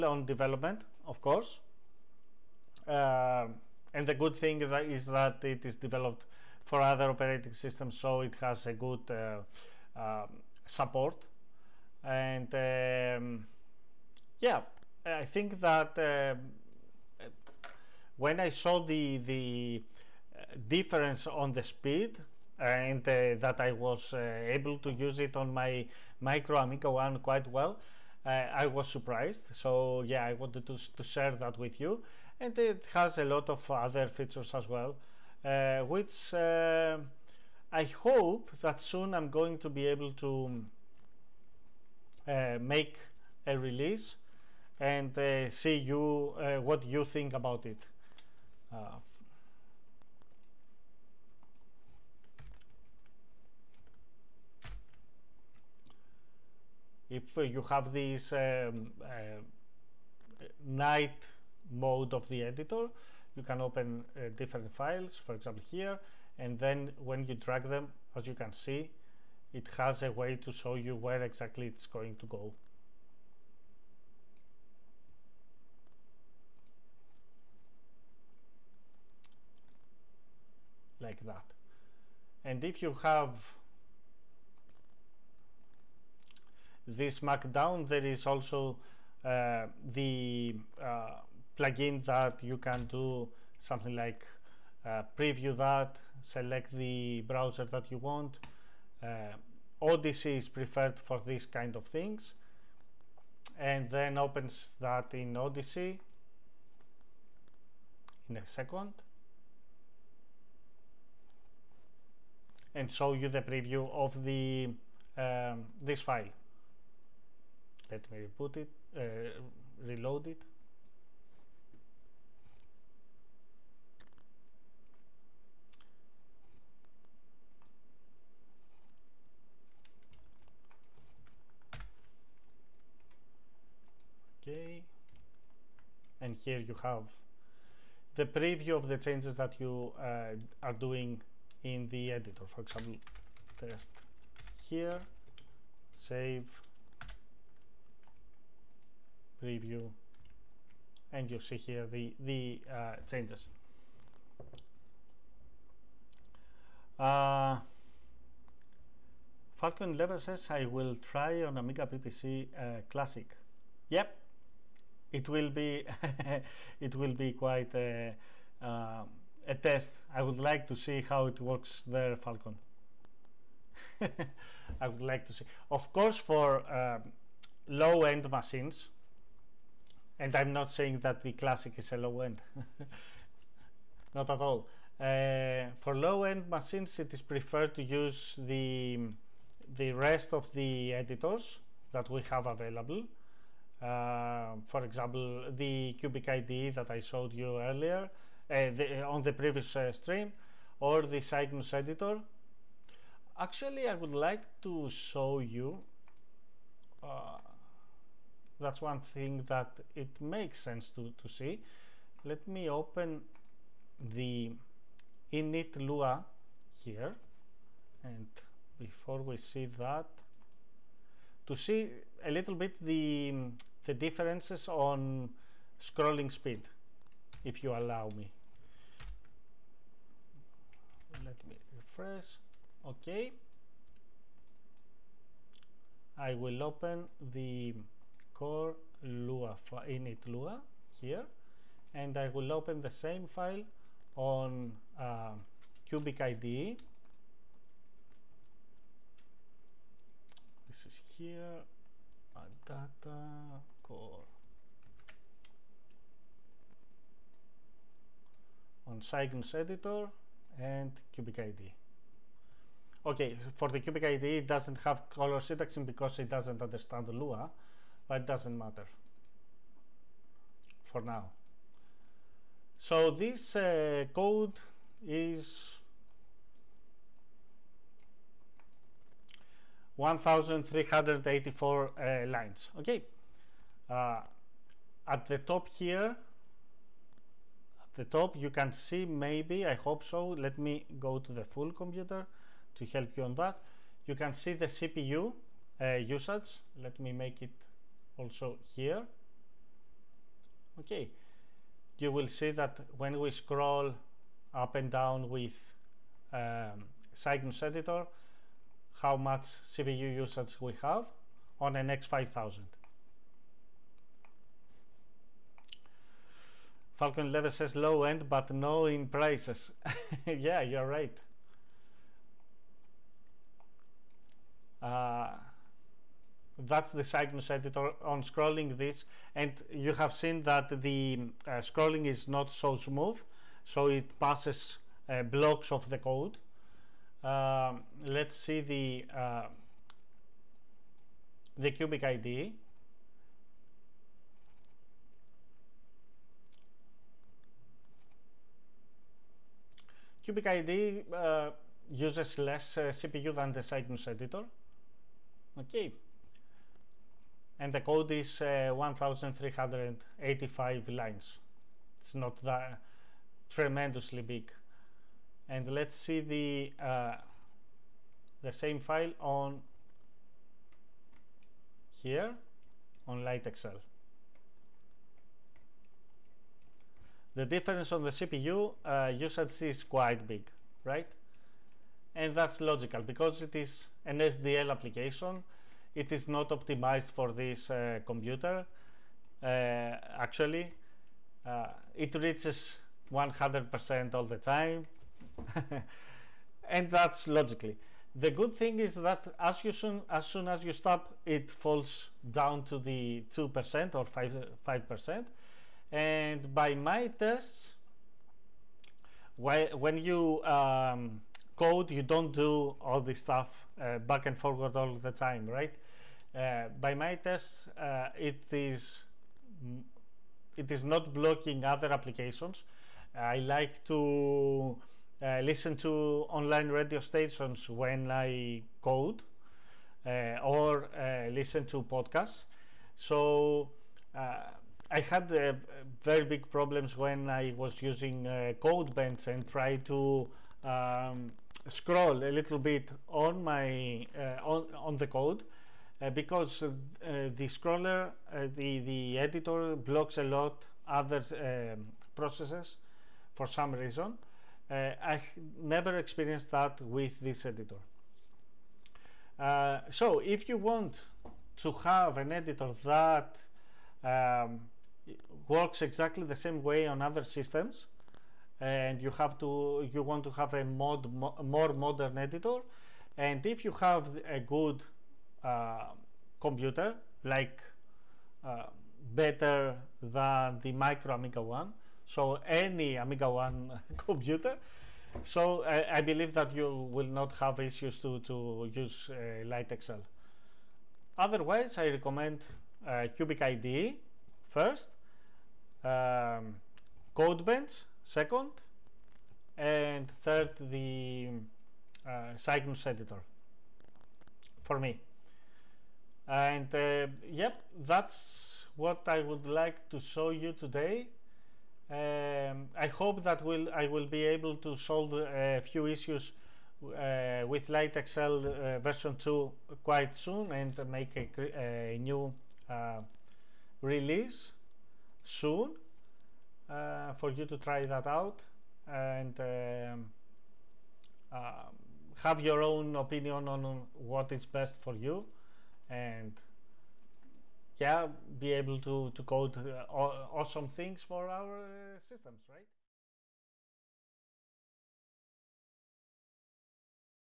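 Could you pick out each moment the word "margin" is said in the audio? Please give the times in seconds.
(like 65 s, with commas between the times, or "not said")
not said.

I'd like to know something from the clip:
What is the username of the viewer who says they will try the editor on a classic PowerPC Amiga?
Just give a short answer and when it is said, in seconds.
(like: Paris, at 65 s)
Falcon 11, at 159 s.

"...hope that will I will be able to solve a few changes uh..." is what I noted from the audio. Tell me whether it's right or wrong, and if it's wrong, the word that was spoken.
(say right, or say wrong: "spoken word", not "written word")
wrong: "issues", not "changes".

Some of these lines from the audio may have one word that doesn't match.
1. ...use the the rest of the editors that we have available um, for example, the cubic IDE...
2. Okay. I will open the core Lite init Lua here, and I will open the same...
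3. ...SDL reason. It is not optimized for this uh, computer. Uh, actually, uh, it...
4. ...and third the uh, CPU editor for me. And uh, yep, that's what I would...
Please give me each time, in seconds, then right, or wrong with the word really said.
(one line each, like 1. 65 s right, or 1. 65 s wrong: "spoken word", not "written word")
1. 187 s right
2. 232 s wrong: "Lua", not "Lite"
3. 384 s wrong: "application", not "reason"
4. 499 s wrong: "Cygnus", not "CPU".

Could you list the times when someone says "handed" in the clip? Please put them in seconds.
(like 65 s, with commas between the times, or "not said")
not said.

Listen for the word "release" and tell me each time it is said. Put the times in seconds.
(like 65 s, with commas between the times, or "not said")
43 s, 523 s.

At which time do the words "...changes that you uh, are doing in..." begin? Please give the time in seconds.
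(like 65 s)
138 s.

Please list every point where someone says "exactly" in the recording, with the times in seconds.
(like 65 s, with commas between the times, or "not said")
71 s, 465 s.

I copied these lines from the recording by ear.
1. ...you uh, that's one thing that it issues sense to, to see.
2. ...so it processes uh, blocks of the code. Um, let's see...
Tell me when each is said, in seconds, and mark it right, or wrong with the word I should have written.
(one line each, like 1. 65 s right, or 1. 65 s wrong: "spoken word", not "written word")
1. 205 s wrong: "makes", not "issues"
2. 333 s wrong: "passes", not "processes".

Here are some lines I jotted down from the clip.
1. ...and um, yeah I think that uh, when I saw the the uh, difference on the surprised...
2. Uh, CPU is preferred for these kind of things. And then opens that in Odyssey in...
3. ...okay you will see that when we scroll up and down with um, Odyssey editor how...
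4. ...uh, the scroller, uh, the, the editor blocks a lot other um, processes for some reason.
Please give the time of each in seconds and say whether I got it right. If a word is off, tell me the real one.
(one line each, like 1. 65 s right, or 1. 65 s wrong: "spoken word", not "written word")
1. 12 s wrong: "speed", not "surprised"
2. 99 s wrong: "Odyssey", not "CPU"
3. 300 s wrong: "Cygnus", not "Odyssey"
4. 446 s right.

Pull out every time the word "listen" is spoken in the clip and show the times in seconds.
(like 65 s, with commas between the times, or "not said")
425 s, 431 s.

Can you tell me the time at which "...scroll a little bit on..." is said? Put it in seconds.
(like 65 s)
441 s.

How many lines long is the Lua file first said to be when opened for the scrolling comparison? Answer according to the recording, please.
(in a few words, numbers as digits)
1384.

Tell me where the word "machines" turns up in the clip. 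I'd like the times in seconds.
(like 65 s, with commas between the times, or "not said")
178 s, 186 s.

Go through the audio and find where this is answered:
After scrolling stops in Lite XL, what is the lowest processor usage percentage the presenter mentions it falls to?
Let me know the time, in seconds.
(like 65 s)
403 s.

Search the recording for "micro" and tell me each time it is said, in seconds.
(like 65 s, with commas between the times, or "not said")
26 s, 480 s.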